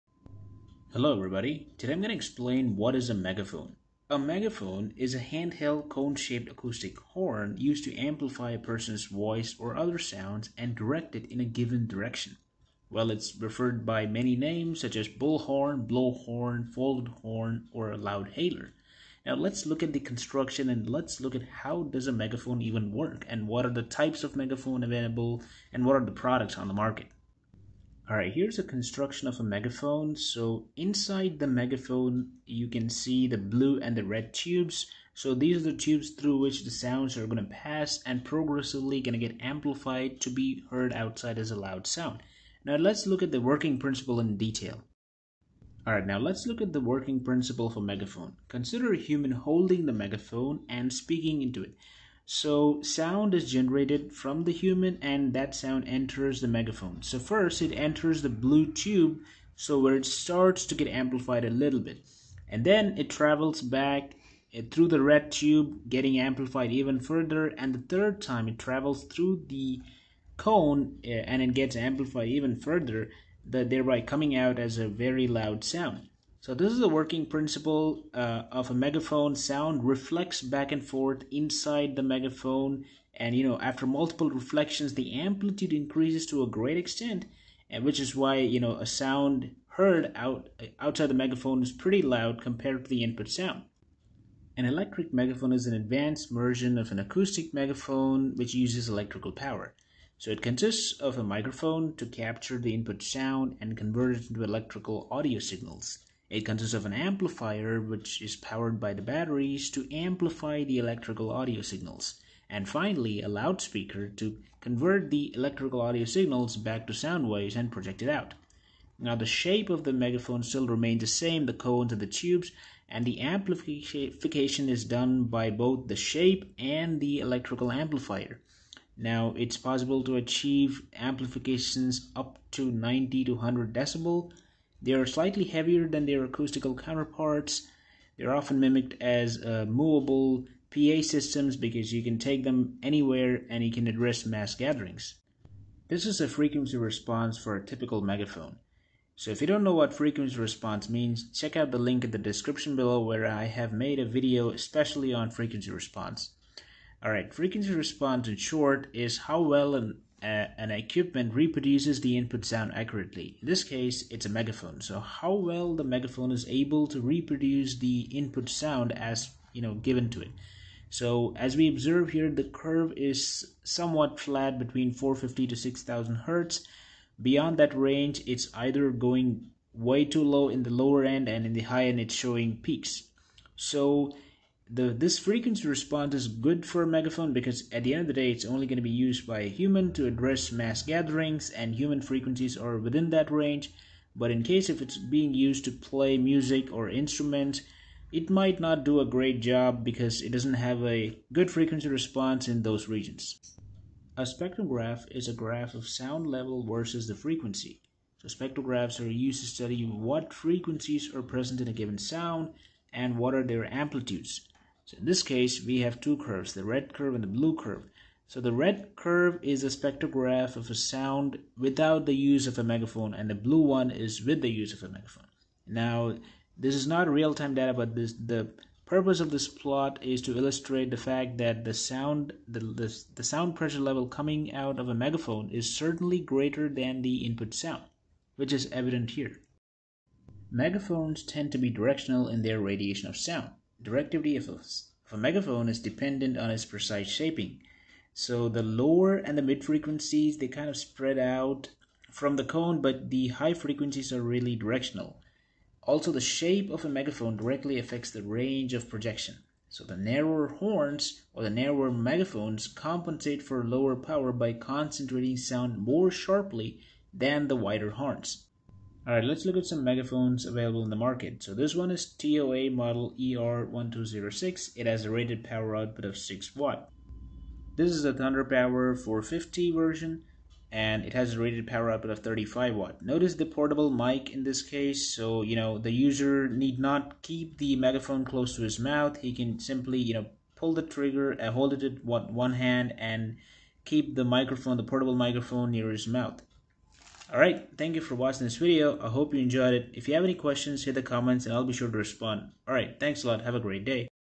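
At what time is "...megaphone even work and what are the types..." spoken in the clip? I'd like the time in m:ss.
0:22.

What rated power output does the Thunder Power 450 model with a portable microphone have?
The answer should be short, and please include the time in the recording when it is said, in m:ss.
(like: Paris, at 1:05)
35 watts, at 4:42.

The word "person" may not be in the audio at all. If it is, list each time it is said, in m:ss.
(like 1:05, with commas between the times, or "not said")
0:08.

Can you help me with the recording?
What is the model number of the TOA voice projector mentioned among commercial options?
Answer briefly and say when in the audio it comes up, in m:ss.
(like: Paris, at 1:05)
ER1206, at 4:33.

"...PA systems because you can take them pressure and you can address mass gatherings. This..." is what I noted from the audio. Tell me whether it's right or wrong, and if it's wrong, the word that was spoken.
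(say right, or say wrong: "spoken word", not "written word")
wrong: "anywhere", not "pressure".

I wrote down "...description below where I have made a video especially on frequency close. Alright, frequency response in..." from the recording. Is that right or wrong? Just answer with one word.
wrong.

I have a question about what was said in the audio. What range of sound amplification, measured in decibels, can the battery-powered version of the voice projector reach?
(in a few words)
90 to 100 decibels.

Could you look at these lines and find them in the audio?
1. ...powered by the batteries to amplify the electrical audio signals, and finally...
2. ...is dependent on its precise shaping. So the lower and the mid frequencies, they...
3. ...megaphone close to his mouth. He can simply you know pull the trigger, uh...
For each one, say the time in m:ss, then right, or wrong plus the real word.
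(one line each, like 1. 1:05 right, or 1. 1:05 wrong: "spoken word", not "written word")
1. 1:48 right
2. 4:05 right
3. 4:47 right.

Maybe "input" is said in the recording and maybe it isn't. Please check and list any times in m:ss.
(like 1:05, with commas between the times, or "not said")
1:33, 1:42, 2:42, 2:48, 3:57.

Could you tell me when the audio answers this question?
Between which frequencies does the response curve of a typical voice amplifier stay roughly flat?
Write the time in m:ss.
2:54.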